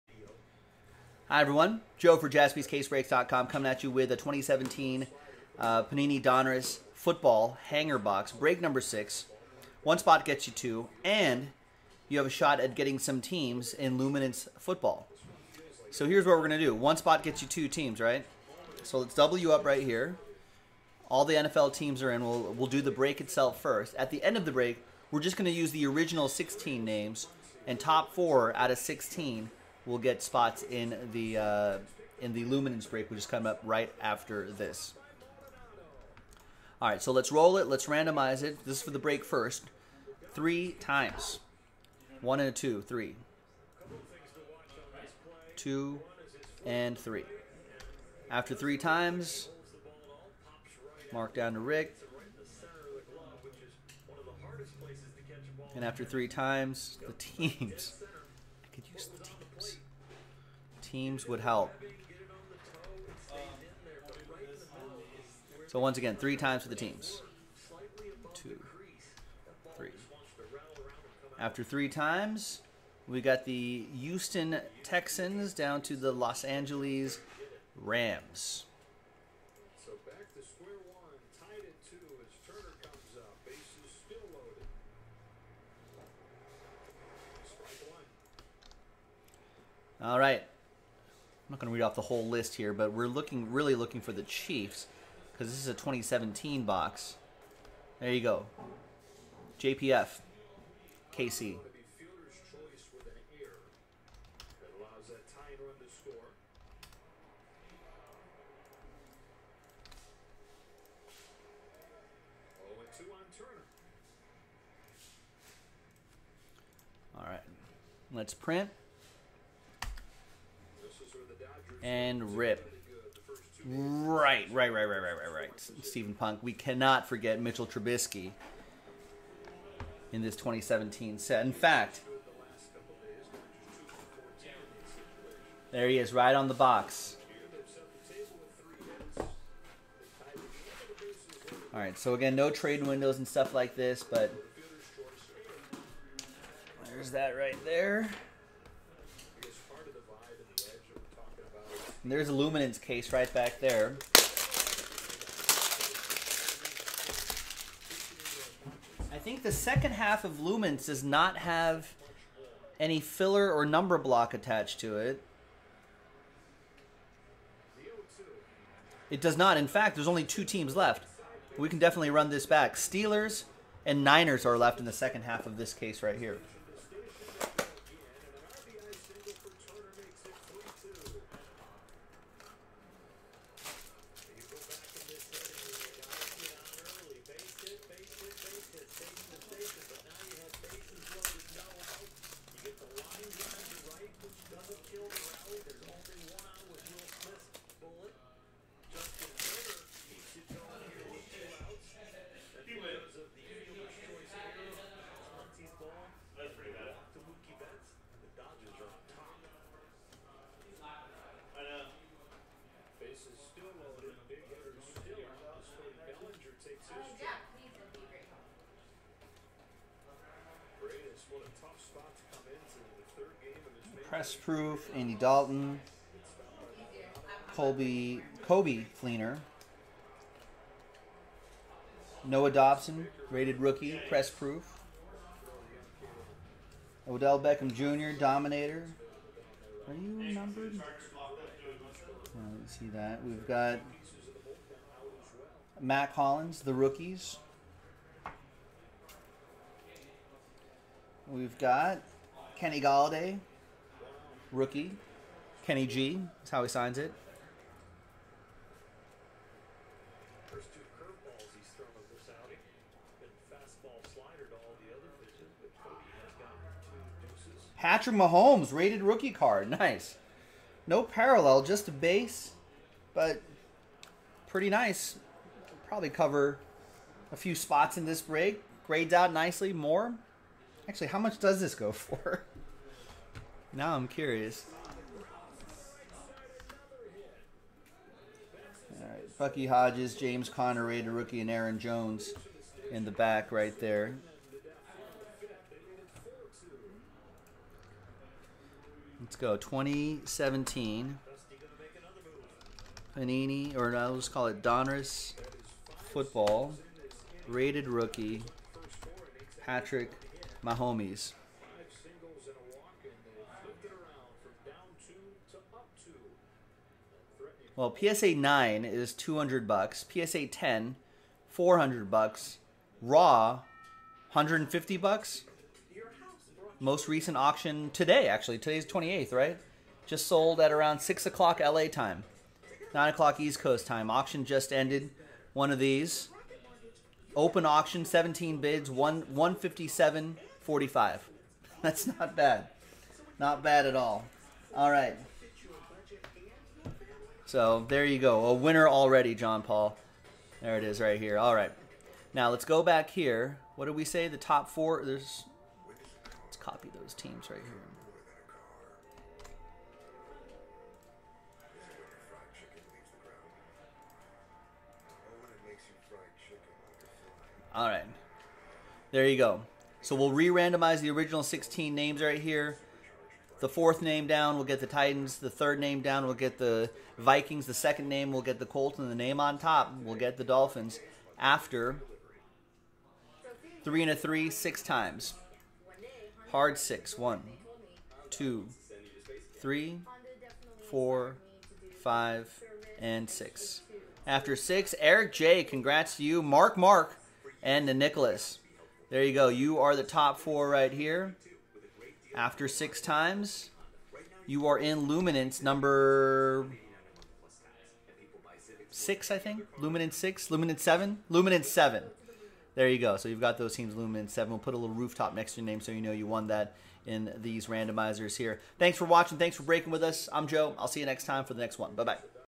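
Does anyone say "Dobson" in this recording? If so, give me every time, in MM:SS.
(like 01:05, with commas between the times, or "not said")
03:52.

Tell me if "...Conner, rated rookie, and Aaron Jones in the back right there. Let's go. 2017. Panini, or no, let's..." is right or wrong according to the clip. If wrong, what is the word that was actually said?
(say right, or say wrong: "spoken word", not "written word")
right.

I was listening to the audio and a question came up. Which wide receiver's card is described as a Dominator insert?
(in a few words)
Odell Beckham Jr.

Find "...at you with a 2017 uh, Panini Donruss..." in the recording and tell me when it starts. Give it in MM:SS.
00:03.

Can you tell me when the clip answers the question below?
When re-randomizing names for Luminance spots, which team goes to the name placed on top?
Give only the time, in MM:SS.
06:20.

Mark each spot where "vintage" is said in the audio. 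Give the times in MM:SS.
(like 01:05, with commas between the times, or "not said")
not said.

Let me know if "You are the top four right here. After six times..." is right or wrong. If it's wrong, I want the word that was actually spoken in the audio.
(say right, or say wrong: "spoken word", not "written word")
right.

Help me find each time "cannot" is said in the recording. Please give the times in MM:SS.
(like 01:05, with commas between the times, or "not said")
02:06.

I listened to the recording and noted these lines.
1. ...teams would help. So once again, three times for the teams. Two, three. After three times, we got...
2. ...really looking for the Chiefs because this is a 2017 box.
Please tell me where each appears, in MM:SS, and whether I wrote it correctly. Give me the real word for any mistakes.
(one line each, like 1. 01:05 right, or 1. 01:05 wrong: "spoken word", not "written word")
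1. 01:00 right
2. 01:33 right.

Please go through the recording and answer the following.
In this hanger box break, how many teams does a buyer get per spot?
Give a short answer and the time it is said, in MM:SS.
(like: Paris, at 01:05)
2, at 00:16.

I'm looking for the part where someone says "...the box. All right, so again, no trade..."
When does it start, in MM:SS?
02:16.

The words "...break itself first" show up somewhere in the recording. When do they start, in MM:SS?
00:22.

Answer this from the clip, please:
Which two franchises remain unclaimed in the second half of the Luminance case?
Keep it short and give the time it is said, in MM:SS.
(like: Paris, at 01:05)
Steelers and Niners, at 02:52.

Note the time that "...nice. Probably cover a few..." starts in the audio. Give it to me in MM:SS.
04:34.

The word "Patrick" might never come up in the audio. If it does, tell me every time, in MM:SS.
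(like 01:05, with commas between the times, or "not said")
04:27, 05:09.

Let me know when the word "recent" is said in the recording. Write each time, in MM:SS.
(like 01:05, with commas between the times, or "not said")
05:27.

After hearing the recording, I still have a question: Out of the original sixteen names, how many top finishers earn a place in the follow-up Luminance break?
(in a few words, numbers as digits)
4.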